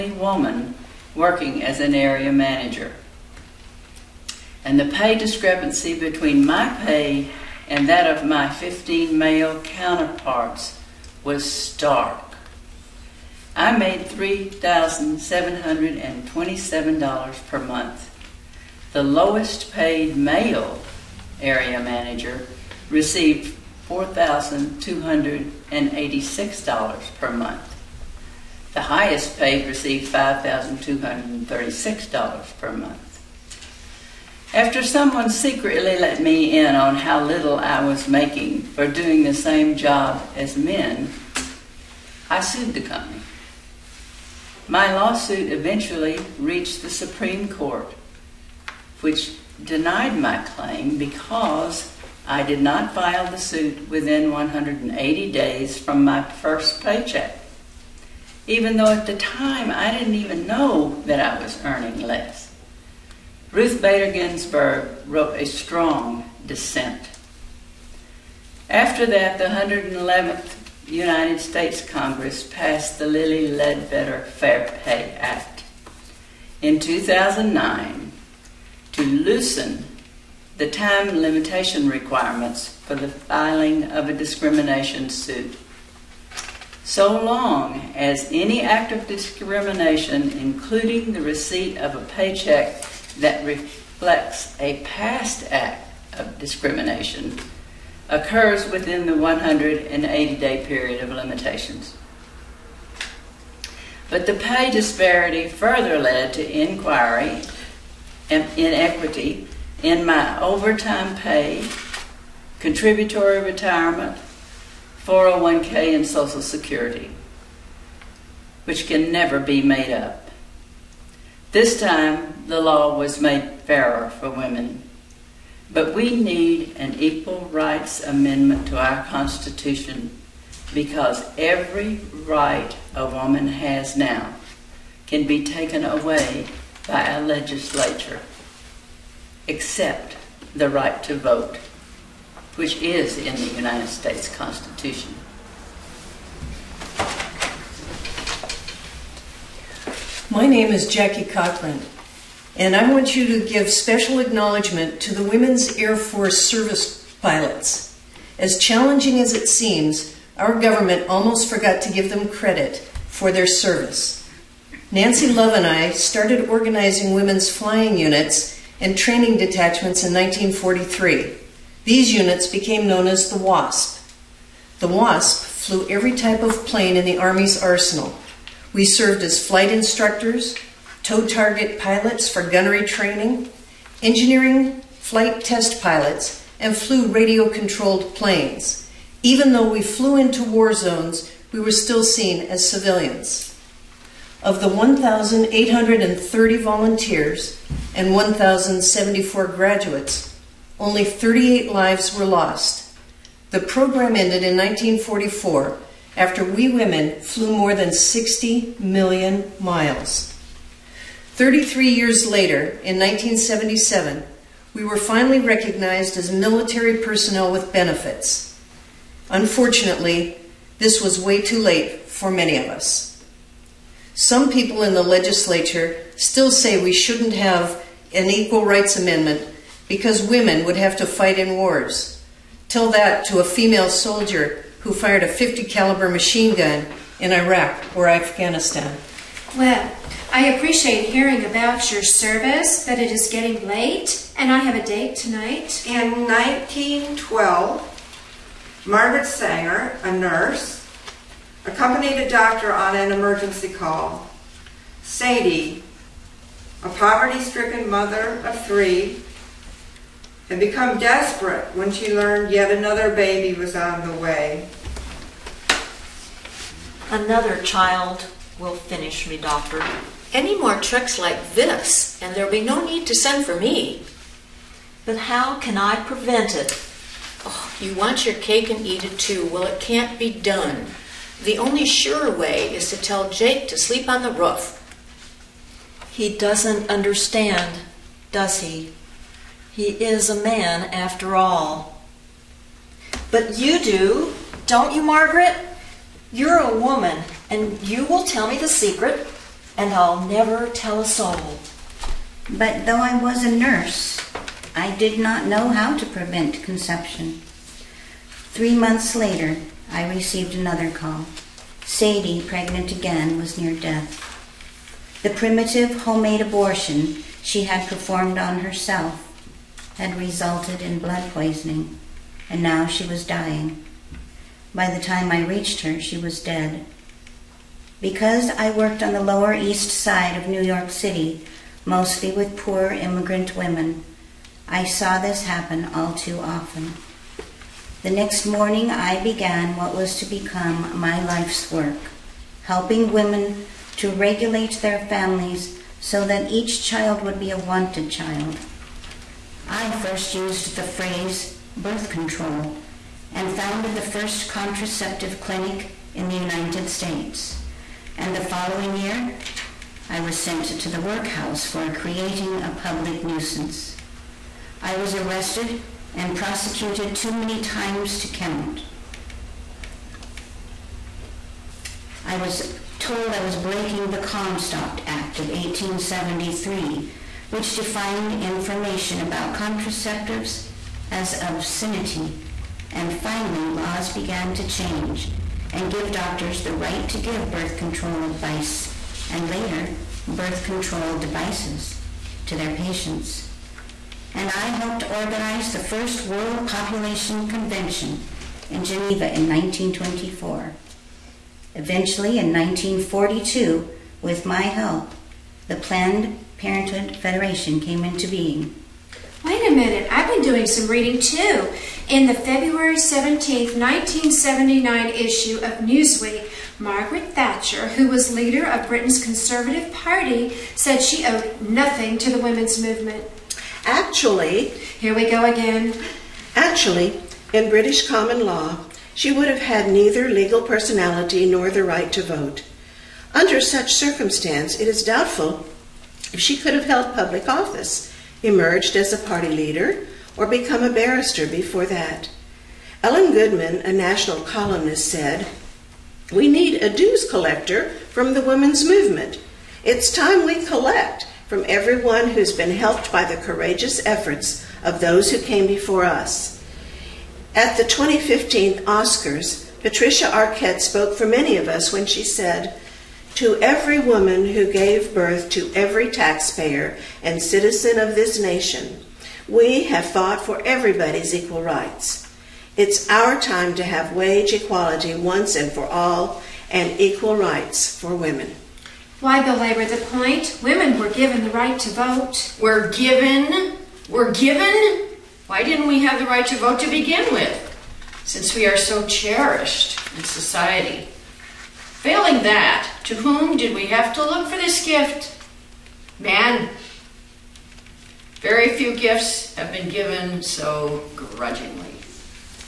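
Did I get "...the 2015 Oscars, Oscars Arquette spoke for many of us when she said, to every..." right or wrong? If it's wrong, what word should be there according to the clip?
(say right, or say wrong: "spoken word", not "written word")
wrong: "Patricia", not "Oscars".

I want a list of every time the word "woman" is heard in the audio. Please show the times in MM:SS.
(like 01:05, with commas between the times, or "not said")
00:00, 02:13, 04:56, 07:43.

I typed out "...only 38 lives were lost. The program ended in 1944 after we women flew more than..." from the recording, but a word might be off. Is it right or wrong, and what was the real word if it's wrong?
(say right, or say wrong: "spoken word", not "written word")
right.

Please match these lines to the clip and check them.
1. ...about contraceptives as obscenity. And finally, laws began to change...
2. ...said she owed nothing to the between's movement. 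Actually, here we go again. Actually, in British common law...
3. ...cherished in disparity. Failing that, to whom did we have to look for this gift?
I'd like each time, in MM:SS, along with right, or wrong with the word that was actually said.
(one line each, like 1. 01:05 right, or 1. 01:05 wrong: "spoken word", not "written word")
1. 06:19 right
2. 07:00 wrong: "women", not "between"
3. 08:09 wrong: "society", not "disparity".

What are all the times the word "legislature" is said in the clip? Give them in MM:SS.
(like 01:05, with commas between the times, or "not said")
02:17, 03:45.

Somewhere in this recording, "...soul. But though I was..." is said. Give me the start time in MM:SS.
05:01.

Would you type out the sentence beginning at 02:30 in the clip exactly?
My name is Jackie Cochran, and I want you to give special acknowledgement to the Women's Air Force Service pilots.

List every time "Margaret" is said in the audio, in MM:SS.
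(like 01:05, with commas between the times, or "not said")
04:08, 04:55, 06:56.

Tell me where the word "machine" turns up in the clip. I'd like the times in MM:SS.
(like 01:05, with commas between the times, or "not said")
03:56.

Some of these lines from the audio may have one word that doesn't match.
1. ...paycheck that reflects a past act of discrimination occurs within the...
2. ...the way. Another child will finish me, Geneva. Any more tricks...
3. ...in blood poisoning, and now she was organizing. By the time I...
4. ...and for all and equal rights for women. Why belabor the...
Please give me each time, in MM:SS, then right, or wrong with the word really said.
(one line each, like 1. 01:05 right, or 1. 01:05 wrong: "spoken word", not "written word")
1. 01:32 right
2. 04:24 wrong: "Doctor", not "Geneva"
3. 05:20 wrong: "dying", not "organizing"
4. 07:55 right.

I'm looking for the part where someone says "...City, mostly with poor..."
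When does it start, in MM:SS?
05:30.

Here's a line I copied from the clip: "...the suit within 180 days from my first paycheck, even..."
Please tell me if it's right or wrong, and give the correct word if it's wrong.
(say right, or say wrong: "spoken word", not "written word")
right.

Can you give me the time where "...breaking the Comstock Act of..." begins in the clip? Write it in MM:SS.
06:13.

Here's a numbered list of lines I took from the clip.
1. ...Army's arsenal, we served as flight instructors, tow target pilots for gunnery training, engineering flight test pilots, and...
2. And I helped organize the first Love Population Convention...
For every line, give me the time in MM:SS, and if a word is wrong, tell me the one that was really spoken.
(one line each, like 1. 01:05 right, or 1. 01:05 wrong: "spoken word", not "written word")
1. 02:57 right
2. 06:34 wrong: "World", not "Love".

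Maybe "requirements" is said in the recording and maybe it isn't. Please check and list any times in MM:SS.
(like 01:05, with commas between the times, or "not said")
01:21.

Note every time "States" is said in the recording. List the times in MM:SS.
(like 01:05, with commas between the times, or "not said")
01:11, 02:23, 05:56.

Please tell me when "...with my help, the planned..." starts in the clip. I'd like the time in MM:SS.
06:44.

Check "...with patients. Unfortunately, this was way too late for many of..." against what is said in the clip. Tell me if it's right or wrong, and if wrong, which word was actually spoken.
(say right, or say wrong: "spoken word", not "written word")
wrong: "benefits", not "patients".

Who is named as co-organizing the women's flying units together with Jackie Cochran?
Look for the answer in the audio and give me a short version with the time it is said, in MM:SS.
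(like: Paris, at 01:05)
Nancy Love, at 02:44.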